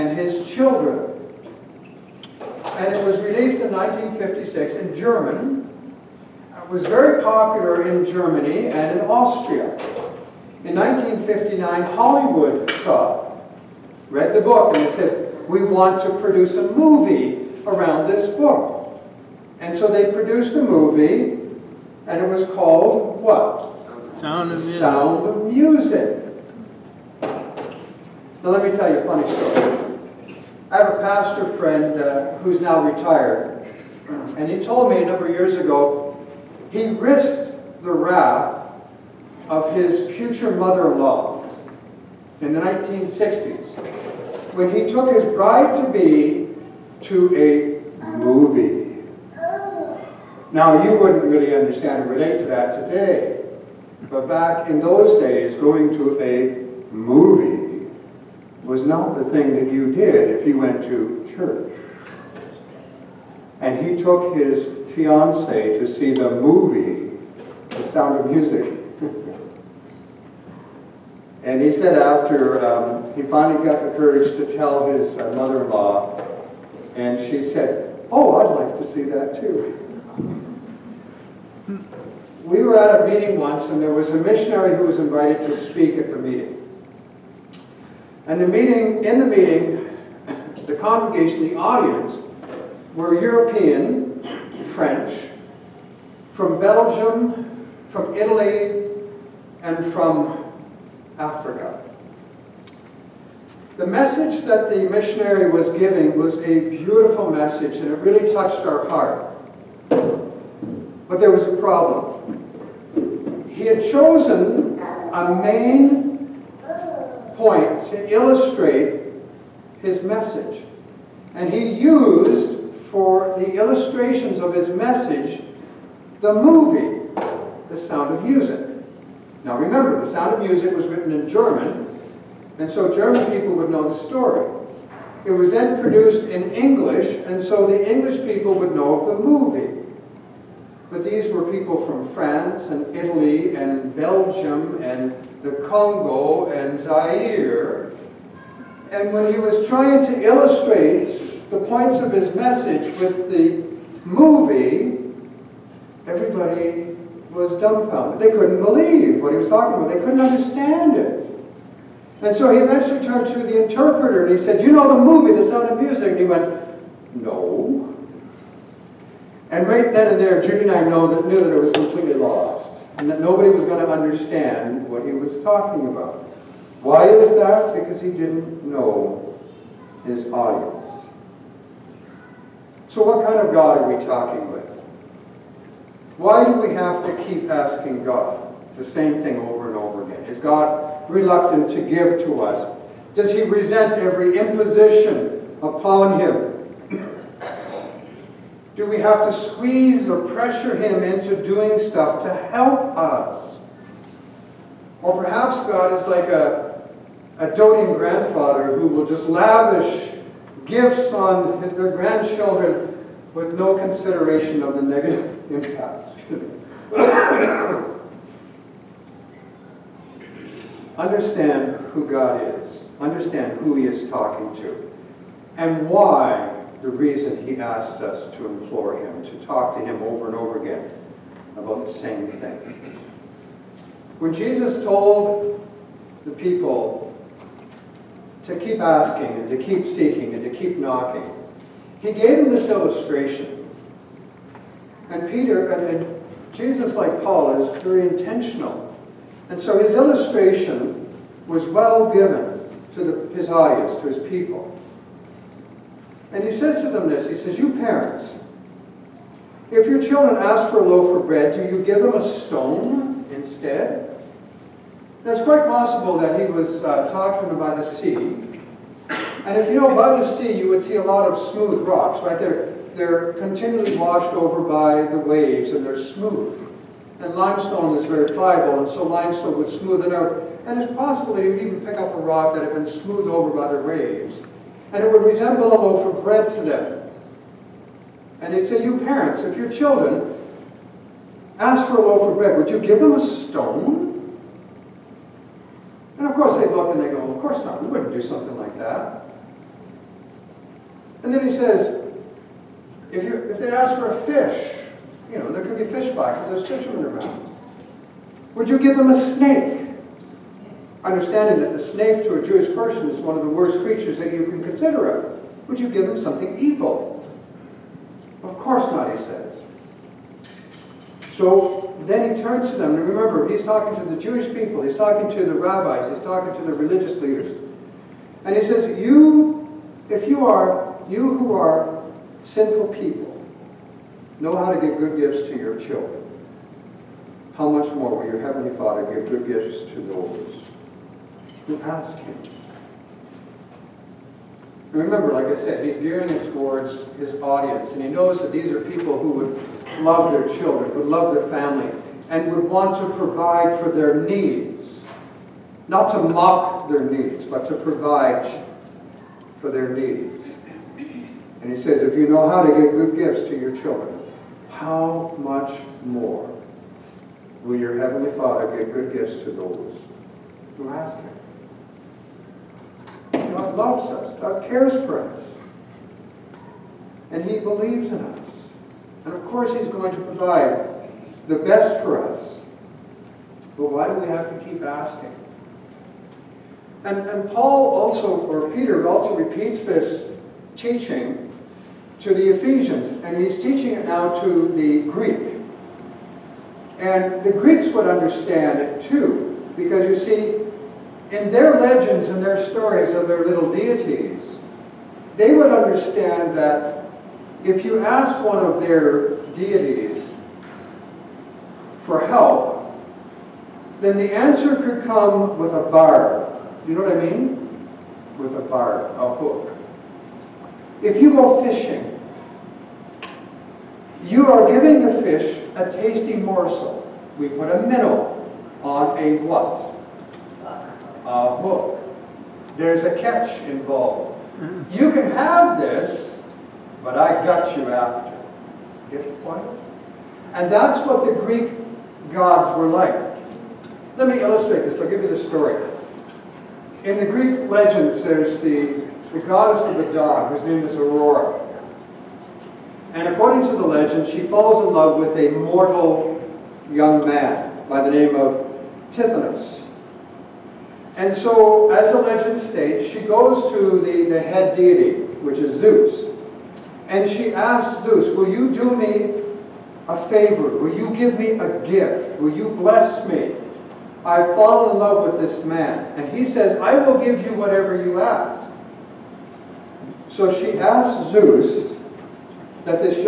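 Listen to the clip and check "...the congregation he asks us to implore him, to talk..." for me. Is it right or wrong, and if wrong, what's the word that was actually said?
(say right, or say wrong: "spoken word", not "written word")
wrong: "reason", not "congregation".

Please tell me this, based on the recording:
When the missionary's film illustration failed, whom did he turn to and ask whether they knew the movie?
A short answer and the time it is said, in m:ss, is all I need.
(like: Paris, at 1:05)
The interpreter, at 2:43.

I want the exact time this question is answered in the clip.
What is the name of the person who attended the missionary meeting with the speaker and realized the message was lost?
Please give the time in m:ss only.
2:50.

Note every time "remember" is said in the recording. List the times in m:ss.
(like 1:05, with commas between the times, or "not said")
2:09, 5:23, 5:45.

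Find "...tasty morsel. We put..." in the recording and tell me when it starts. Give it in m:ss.
7:05.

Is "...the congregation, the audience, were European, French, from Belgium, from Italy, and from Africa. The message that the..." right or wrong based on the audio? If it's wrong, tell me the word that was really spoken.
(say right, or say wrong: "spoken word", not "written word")
right.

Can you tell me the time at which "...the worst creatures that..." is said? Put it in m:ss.
5:13.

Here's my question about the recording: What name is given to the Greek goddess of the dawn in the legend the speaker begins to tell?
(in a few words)
Aurora.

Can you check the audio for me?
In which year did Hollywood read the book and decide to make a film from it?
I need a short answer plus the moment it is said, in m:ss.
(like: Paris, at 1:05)
1959, at 0:10.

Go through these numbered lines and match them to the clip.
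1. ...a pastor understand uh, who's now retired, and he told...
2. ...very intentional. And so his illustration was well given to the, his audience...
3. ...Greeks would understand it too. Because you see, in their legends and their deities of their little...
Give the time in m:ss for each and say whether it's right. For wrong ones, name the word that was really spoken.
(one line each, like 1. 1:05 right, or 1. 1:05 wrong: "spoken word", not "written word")
1. 0:30 wrong: "friend", not "understand"
2. 4:07 right
3. 6:37 wrong: "stories", not "deities".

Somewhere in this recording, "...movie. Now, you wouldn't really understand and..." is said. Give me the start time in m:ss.
0:48.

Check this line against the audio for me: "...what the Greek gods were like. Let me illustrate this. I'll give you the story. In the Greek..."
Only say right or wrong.
right.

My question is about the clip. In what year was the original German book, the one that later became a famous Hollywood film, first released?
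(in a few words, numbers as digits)
1956.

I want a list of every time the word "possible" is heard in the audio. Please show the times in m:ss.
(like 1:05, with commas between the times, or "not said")
4:25, 4:40.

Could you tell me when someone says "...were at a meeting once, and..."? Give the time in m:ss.
1:22.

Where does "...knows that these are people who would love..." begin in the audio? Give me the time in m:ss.
5:48.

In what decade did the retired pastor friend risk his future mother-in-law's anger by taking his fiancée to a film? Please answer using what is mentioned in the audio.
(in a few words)
1960s.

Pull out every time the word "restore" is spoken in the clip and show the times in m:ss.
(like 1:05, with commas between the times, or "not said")
not said.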